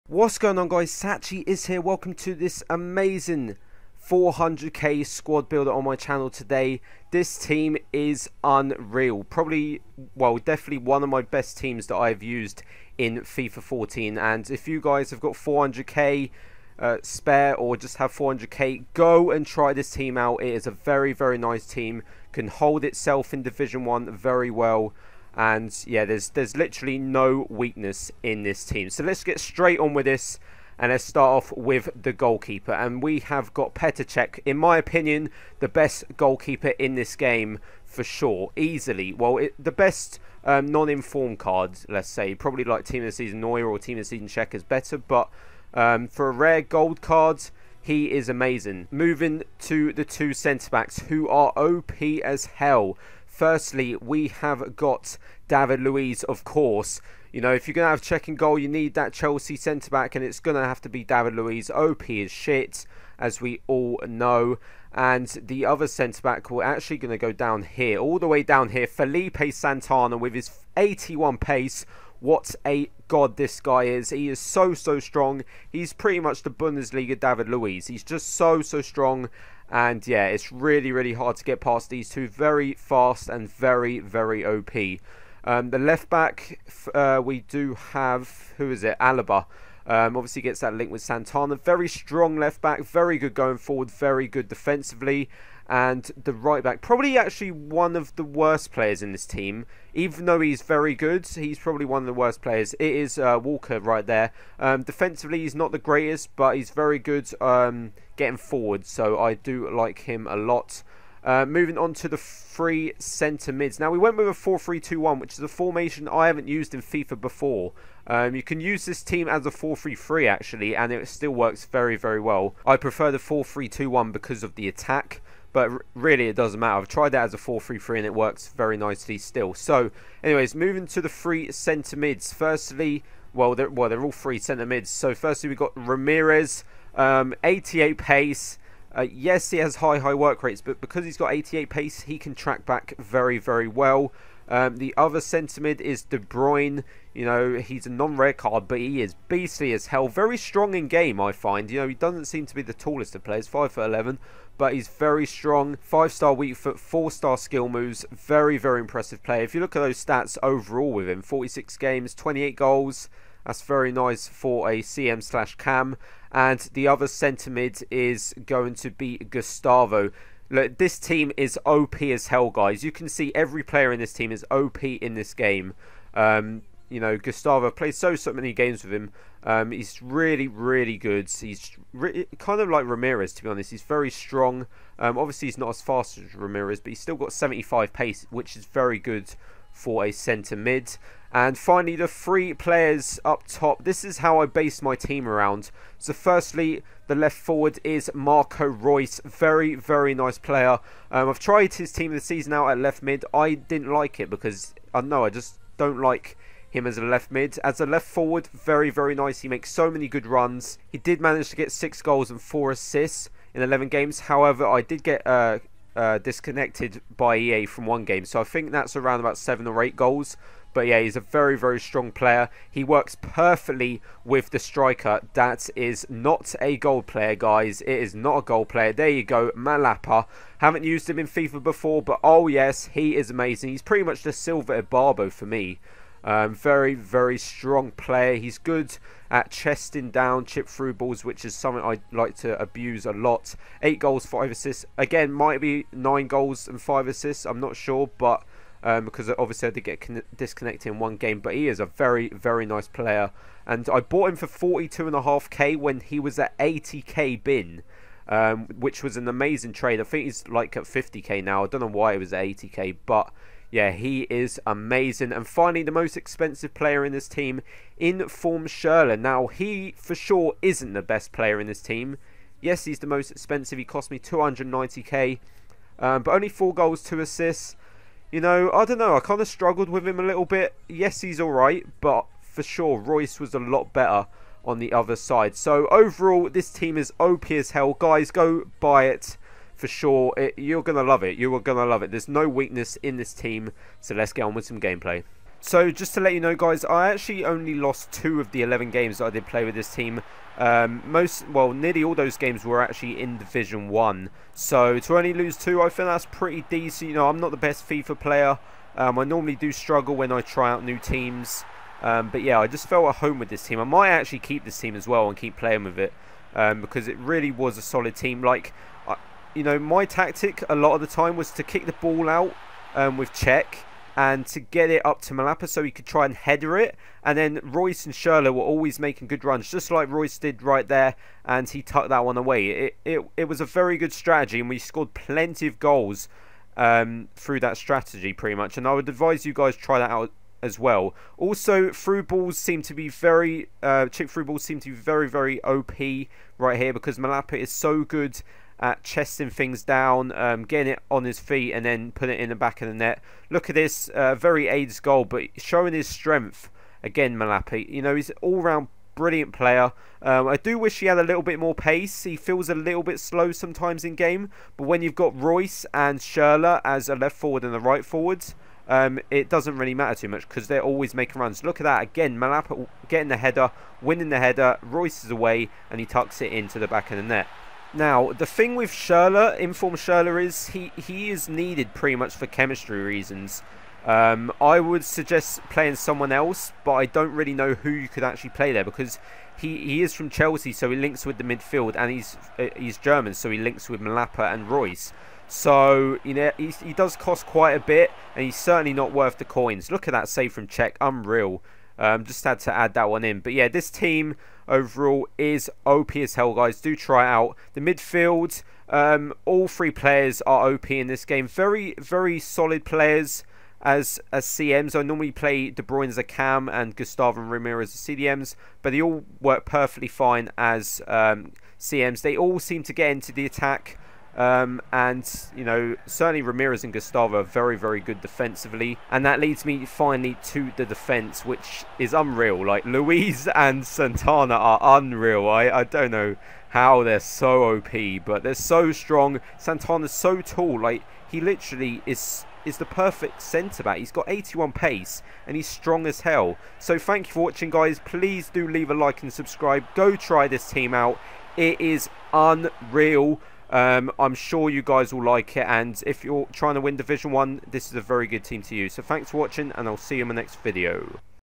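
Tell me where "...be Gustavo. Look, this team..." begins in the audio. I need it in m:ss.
2:48.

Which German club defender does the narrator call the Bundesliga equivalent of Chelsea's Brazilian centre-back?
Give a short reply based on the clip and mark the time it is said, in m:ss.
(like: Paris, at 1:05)
Felipe Santana, at 1:08.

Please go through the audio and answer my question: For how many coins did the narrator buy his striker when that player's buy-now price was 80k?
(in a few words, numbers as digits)
42.5k.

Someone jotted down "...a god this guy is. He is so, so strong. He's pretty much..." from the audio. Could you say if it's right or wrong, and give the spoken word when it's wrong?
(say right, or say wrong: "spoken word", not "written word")
right.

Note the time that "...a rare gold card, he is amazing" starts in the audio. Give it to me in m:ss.
0:46.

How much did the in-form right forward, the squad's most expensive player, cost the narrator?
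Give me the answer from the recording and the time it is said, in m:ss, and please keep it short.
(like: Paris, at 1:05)
290k, at 4:34.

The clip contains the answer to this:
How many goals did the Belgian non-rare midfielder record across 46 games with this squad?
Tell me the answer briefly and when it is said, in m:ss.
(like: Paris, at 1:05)
28, at 2:42.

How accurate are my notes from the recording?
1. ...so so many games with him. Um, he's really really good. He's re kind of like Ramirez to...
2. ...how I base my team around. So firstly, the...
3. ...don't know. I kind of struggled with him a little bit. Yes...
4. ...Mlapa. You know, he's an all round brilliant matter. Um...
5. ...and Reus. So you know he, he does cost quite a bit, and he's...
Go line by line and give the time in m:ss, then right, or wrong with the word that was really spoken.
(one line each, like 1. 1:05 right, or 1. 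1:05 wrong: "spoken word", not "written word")
1. 2:57 right
2. 3:14 right
3. 4:38 right
4. 5:57 wrong: "player", not "matter"
5. 6:34 right.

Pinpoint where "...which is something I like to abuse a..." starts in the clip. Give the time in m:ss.
4:01.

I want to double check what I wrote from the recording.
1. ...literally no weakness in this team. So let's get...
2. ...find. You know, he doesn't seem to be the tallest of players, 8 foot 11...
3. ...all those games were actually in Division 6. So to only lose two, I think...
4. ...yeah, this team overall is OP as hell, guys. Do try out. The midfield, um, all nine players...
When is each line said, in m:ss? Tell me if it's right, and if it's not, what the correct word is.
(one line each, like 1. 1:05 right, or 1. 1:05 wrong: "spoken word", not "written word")
1. 0:26 right
2. 2:31 wrong: "5", not "8"
3. 5:02 wrong: "1", not "6"
4. 6:43 wrong: "three", not "nine".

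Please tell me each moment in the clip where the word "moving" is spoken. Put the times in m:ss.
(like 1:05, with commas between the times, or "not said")
0:48, 1:51, 2:10.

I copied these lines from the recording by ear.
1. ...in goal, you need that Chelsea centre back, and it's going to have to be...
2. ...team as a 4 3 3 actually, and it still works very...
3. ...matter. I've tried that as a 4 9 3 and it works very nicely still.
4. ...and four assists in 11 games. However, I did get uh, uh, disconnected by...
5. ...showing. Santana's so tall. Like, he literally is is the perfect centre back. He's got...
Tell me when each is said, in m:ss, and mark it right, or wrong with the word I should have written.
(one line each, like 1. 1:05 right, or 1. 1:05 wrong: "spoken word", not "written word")
1. 0:58 right
2. 1:59 right
3. 2:06 wrong: "3", not "9"
4. 3:32 right
5. 7:18 wrong: "strong", not "showing".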